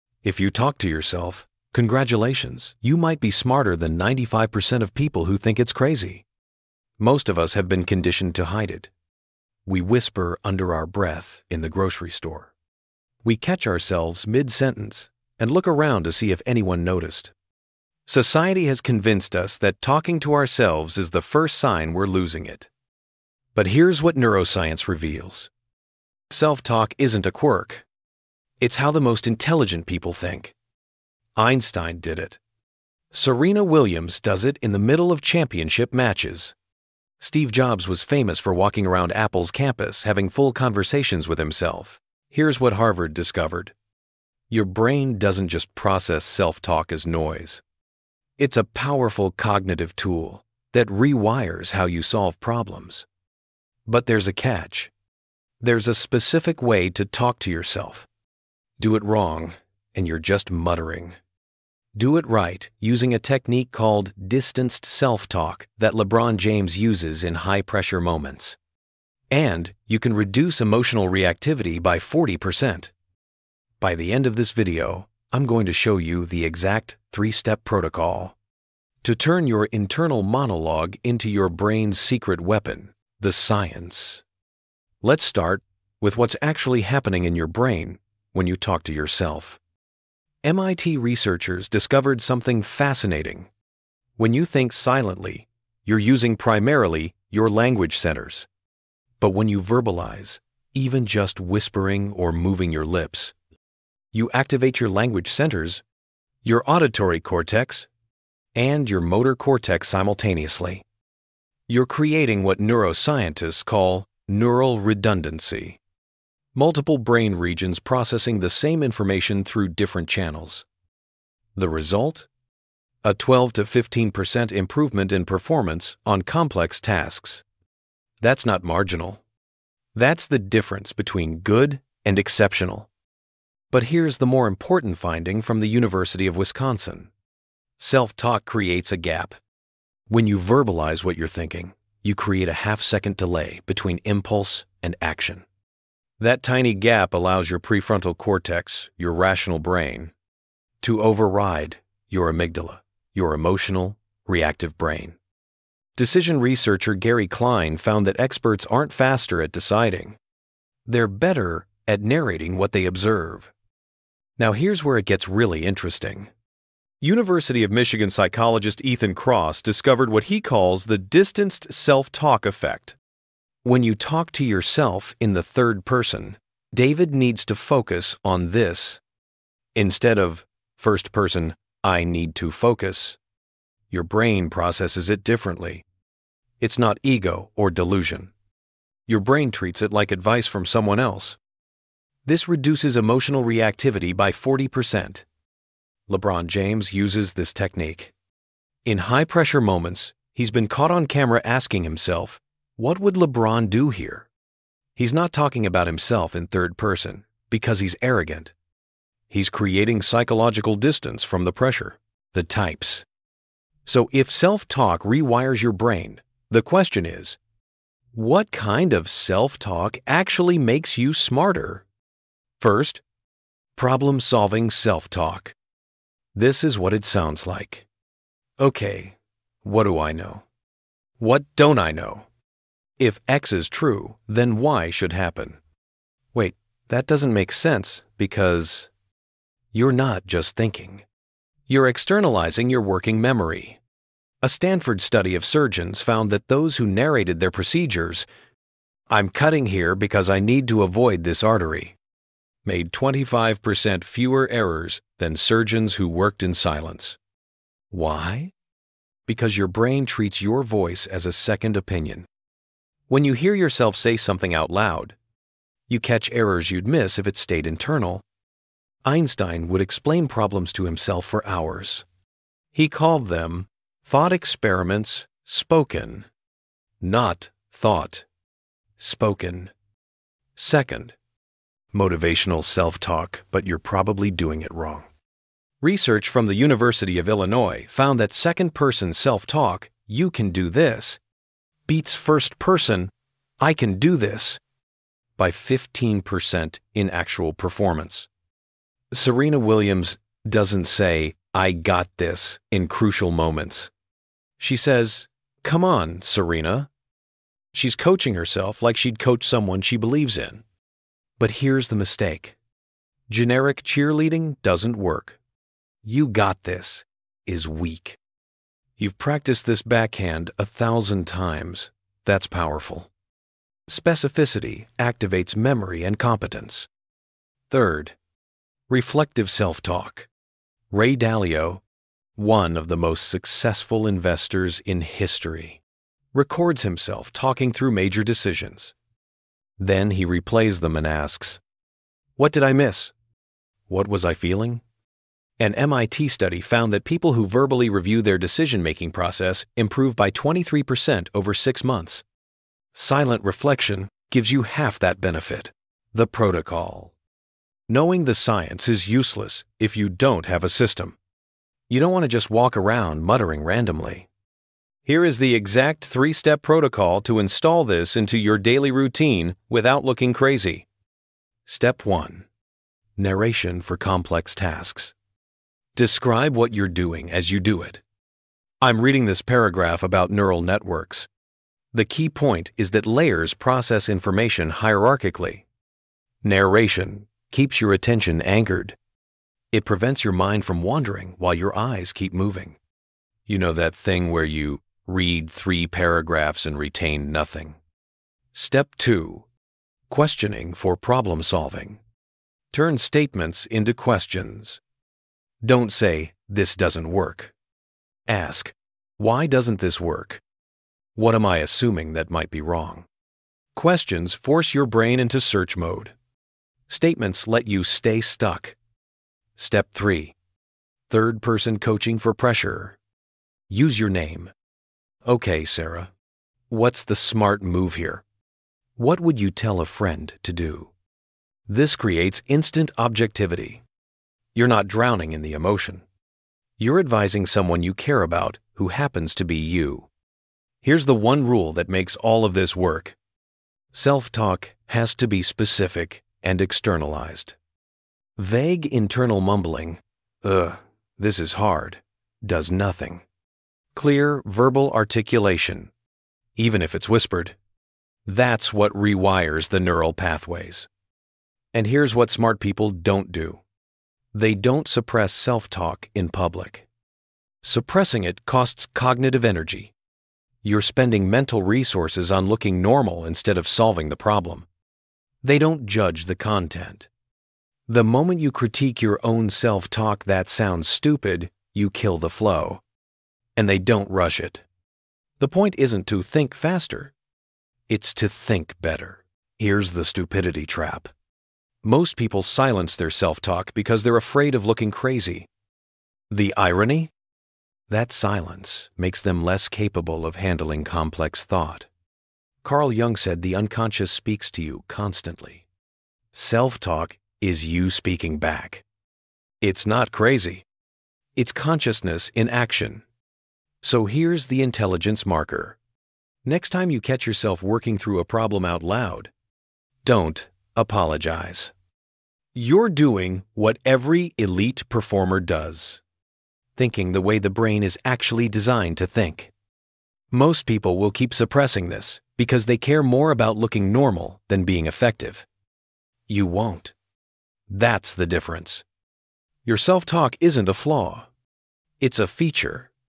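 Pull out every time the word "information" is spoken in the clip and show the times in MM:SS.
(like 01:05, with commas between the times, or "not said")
01:58, 06:24.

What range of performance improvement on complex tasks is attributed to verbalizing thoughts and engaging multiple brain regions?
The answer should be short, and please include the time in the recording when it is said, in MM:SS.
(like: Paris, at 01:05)
12 to 15%, at 02:03.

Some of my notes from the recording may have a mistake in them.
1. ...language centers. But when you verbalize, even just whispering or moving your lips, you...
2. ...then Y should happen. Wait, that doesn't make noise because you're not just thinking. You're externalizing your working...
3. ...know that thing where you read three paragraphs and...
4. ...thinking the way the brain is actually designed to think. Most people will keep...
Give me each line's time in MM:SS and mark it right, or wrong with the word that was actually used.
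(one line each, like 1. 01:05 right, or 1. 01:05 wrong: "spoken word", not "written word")
1. 01:37 right
2. 03:54 wrong: "sense", not "noise"
3. 06:33 right
4. 08:46 right.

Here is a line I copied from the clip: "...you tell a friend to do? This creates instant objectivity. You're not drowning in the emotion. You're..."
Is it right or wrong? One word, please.
right.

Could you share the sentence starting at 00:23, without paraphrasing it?
But here's what neuroscience reveals self talk isn't a quirk, it's how the most intelligent people think.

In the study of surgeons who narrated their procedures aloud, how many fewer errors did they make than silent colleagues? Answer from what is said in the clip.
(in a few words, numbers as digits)
25%.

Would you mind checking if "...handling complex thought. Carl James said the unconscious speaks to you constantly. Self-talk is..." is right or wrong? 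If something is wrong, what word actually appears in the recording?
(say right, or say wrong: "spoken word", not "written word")
wrong: "Jung", not "James".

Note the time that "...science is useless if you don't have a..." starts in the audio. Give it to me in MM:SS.
05:58.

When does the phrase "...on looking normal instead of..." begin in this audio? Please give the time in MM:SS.
07:52.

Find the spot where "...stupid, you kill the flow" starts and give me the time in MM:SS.
08:00.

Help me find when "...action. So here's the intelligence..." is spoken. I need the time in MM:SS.
08:32.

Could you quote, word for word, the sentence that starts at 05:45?
An MIT study found that people who verbally review their decision making process improve by 23% over six months.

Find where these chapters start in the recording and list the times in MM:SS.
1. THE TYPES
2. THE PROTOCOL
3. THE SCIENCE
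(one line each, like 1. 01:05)
1. 03:32
2. 05:55
3. 01:23.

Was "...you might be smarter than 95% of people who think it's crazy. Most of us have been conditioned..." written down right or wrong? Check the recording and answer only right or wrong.
right.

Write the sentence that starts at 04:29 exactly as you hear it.
Einstein would explain problems to himself for hours.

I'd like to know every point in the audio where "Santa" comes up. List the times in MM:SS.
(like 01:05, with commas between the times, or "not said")
not said.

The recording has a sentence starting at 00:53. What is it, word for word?
But there's a catch there's a specific way to talk to yourself do it wrong, and you're just muttering.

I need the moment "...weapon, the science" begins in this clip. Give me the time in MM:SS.
01:22.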